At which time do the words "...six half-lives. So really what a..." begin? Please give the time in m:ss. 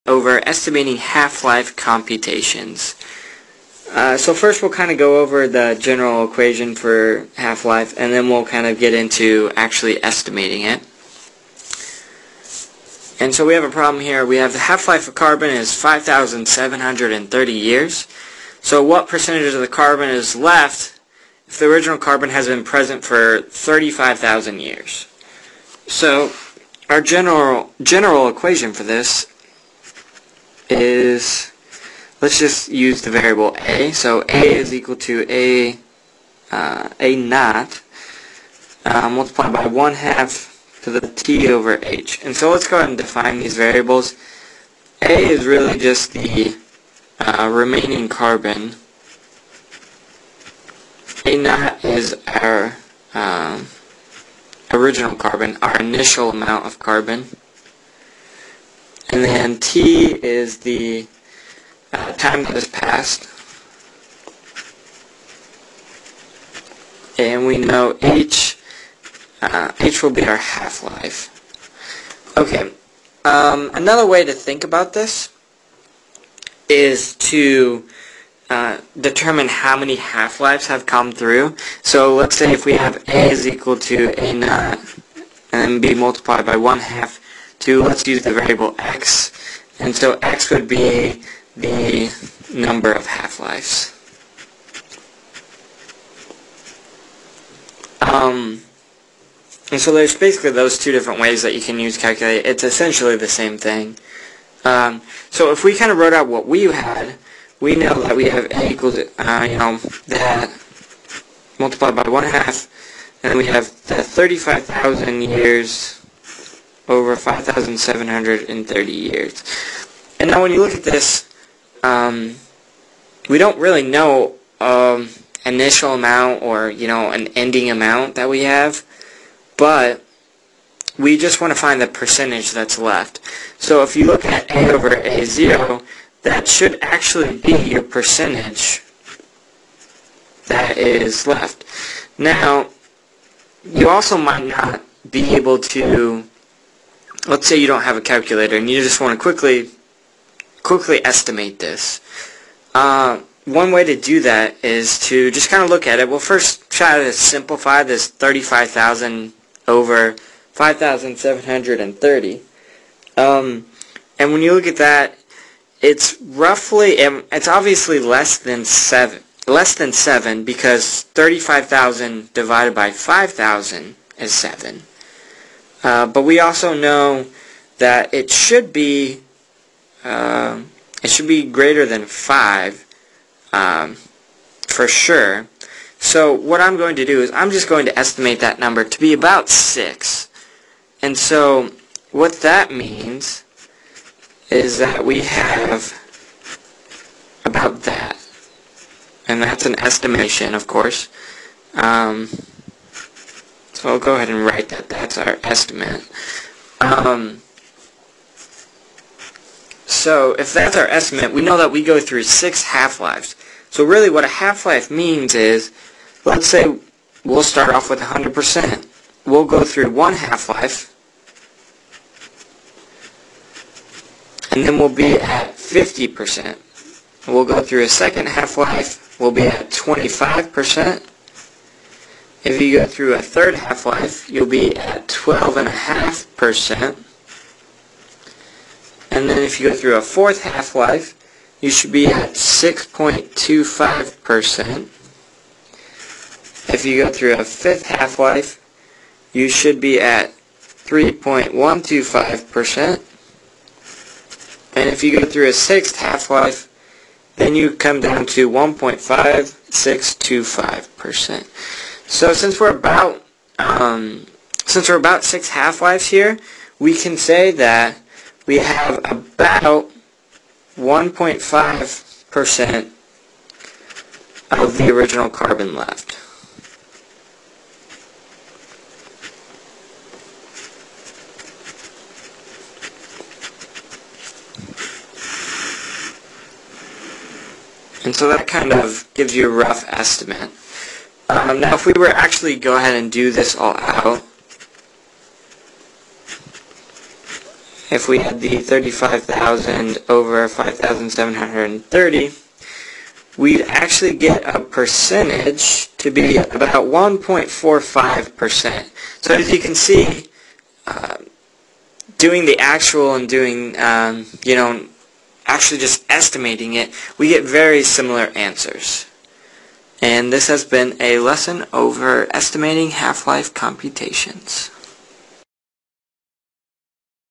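3:32.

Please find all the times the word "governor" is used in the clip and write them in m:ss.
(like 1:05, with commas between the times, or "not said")
not said.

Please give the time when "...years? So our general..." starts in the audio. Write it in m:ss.
0:24.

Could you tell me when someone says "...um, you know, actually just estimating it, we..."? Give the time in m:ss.
5:13.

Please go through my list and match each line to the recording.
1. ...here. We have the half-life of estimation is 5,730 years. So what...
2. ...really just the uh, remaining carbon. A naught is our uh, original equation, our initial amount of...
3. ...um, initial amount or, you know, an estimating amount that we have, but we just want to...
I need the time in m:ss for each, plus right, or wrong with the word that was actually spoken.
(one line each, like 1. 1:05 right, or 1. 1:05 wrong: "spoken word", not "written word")
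1. 0:14 wrong: "carbon", not "estimation"
2. 0:45 wrong: "carbon", not "equation"
3. 2:04 wrong: "ending", not "estimating".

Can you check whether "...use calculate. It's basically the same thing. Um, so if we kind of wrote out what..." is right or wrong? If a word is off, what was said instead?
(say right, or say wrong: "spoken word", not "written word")
wrong: "essentially", not "basically".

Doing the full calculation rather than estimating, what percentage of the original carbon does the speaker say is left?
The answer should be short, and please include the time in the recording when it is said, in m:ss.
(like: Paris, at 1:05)
1.45%, at 5:06.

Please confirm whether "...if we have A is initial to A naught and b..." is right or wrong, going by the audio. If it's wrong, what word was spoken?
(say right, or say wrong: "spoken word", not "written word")
wrong: "equal", not "initial".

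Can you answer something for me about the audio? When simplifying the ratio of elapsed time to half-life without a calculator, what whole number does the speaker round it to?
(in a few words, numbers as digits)
6.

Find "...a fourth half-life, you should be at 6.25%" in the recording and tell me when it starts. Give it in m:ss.
3:59.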